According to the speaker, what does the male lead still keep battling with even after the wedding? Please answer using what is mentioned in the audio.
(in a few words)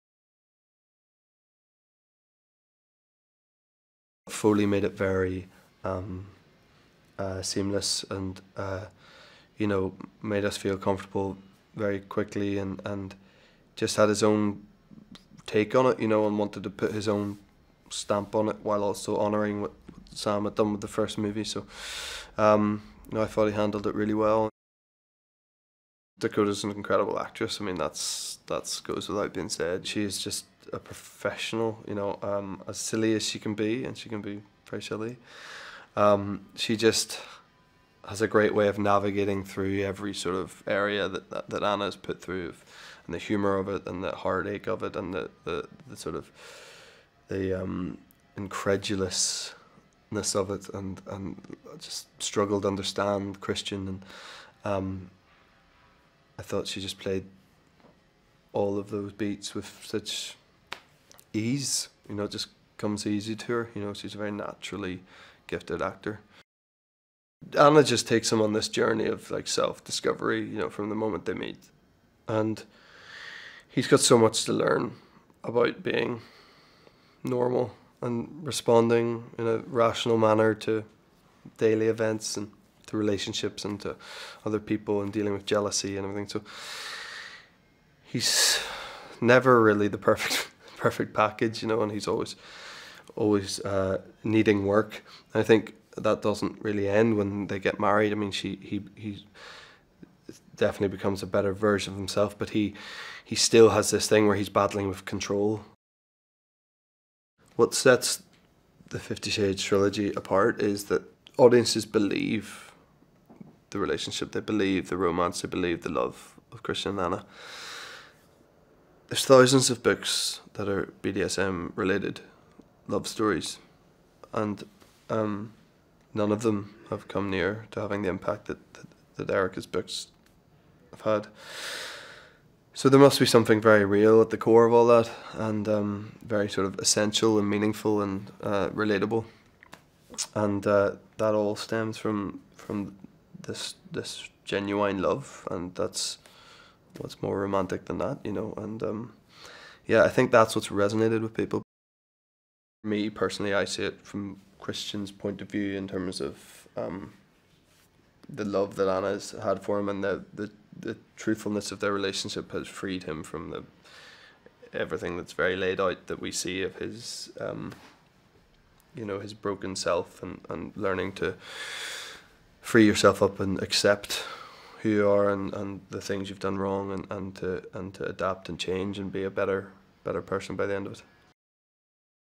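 Control.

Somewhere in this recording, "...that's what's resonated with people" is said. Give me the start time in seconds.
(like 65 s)
150 s.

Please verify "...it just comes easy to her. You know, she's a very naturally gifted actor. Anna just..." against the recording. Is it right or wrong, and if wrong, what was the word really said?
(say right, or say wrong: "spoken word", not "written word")
right.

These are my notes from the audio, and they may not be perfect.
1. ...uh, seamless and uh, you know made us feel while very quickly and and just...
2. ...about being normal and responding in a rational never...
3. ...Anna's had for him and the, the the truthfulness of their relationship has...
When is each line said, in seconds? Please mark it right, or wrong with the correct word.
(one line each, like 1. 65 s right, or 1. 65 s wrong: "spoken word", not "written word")
1. 7 s wrong: "comfortable", not "while"
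2. 75 s wrong: "manner", not "never"
3. 158 s right.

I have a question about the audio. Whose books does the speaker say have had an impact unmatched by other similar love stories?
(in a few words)
Erika.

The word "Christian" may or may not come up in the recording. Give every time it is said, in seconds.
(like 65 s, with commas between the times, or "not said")
53 s, 116 s, 154 s.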